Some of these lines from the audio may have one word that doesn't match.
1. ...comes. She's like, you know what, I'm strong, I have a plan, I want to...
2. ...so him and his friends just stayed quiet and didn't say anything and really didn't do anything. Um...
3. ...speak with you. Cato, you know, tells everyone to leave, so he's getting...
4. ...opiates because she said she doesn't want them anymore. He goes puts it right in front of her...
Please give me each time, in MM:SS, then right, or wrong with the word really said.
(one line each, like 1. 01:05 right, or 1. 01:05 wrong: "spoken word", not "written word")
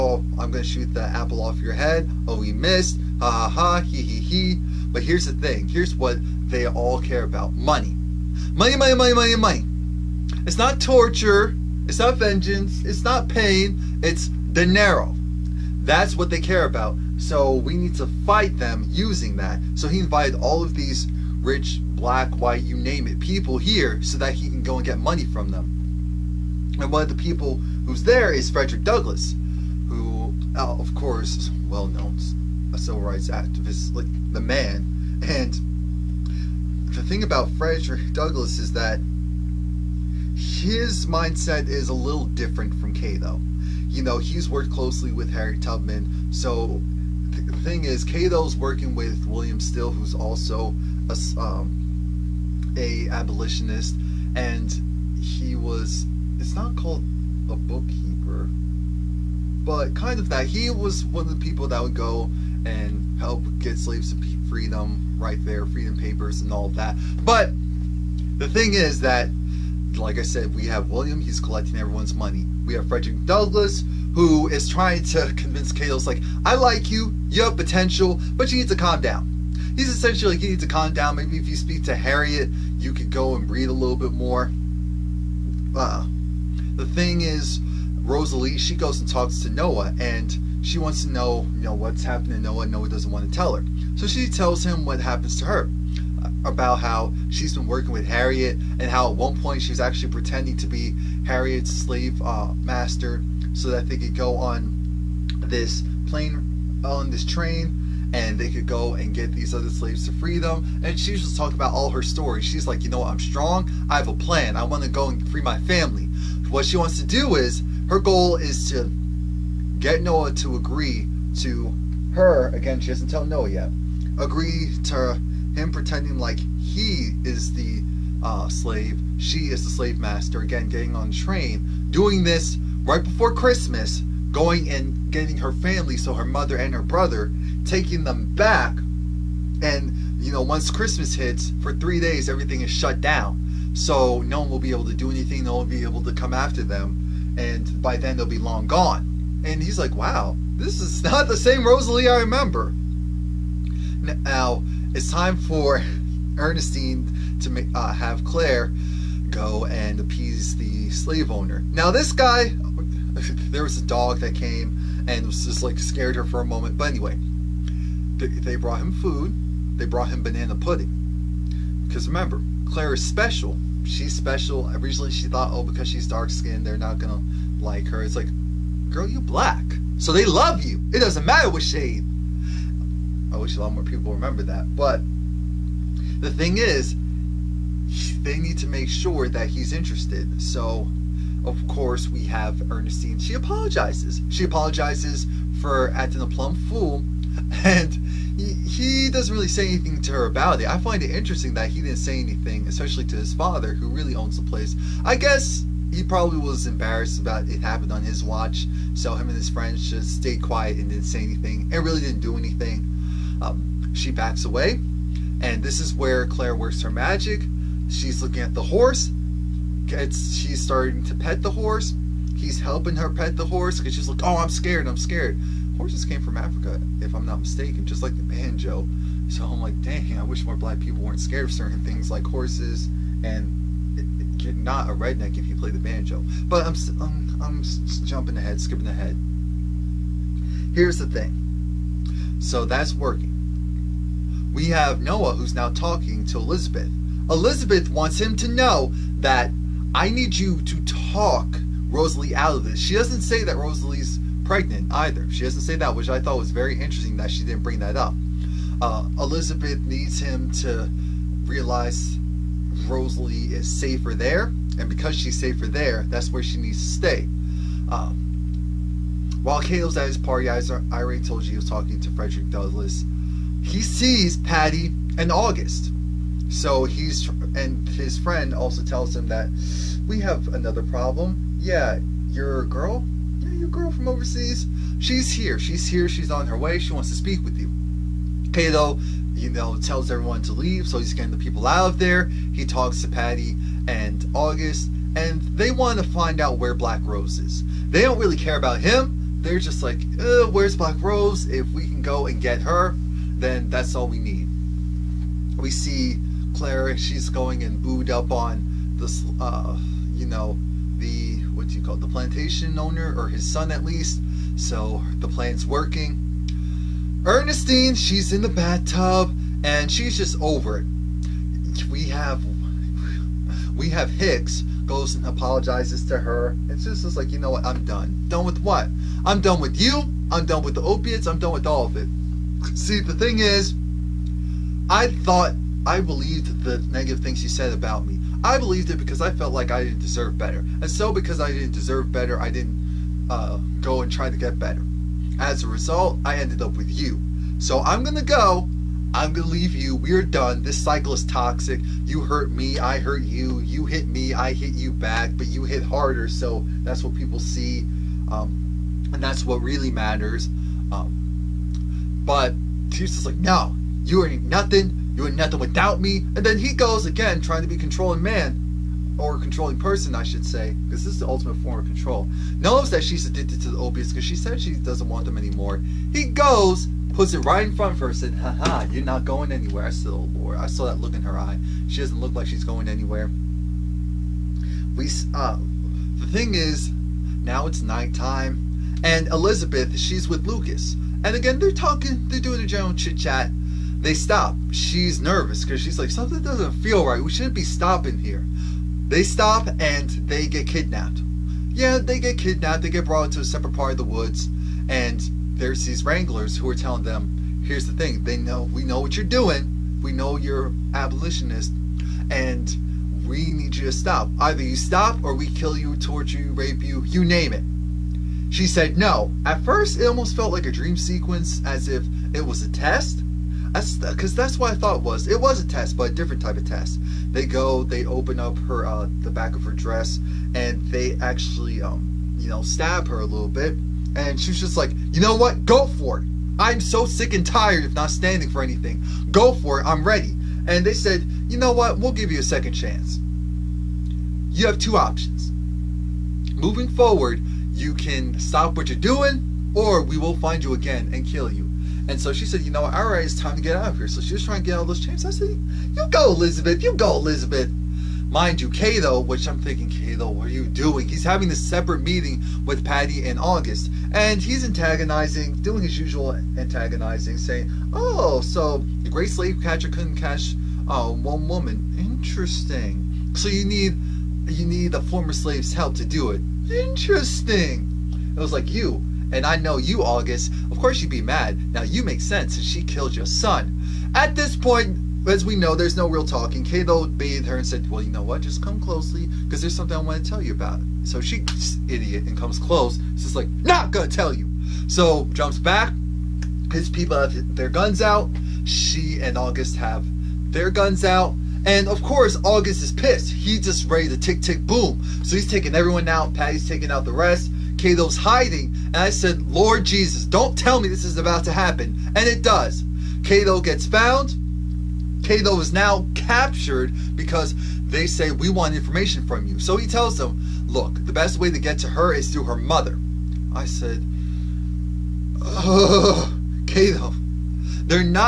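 1. 01:52 wrong: "stories", not "comes"
2. 03:28 right
3. 04:47 right
4. 06:13 right.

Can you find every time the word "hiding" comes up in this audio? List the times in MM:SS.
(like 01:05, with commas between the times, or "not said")
08:28.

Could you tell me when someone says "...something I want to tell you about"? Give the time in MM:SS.
08:09.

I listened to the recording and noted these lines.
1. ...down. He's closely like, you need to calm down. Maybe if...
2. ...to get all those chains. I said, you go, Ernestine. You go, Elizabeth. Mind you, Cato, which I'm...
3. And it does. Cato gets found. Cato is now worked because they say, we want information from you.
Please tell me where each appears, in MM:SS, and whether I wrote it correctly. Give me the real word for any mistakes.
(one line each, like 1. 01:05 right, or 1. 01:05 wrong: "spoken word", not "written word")
1. 01:18 wrong: "essentially", not "closely"
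2. 07:34 wrong: "Elizabeth", not "Ernestine"
3. 08:32 wrong: "captured", not "worked".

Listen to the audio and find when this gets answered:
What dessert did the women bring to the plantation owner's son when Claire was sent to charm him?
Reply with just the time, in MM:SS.
02:50.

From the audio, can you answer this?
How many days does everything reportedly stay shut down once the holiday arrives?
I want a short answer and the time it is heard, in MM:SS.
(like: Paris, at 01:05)
3, at 02:21.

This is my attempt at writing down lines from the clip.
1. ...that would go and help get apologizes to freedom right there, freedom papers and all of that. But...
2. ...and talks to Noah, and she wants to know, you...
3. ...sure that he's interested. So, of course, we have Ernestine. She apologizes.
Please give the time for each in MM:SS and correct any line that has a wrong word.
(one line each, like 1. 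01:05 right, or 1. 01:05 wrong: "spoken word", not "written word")
1. 01:01 wrong: "slaves", not "apologizes"
2. 01:28 right
3. 03:08 right.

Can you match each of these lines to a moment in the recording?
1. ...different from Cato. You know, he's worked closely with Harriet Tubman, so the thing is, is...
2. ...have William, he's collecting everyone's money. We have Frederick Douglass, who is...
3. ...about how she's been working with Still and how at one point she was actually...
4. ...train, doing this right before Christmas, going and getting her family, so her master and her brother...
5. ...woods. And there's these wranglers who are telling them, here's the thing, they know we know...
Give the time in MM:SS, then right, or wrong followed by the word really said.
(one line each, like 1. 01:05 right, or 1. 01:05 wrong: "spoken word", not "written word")
1. 00:42 right
2. 01:10 right
3. 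01:36 wrong: "Harriet", not "Still"
4. 02:11 wrong: "mother", not "master"
5. 06:44 right.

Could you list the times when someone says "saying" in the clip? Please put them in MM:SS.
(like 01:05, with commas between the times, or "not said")
07:47.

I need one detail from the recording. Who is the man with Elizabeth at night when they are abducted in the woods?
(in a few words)
Lucas.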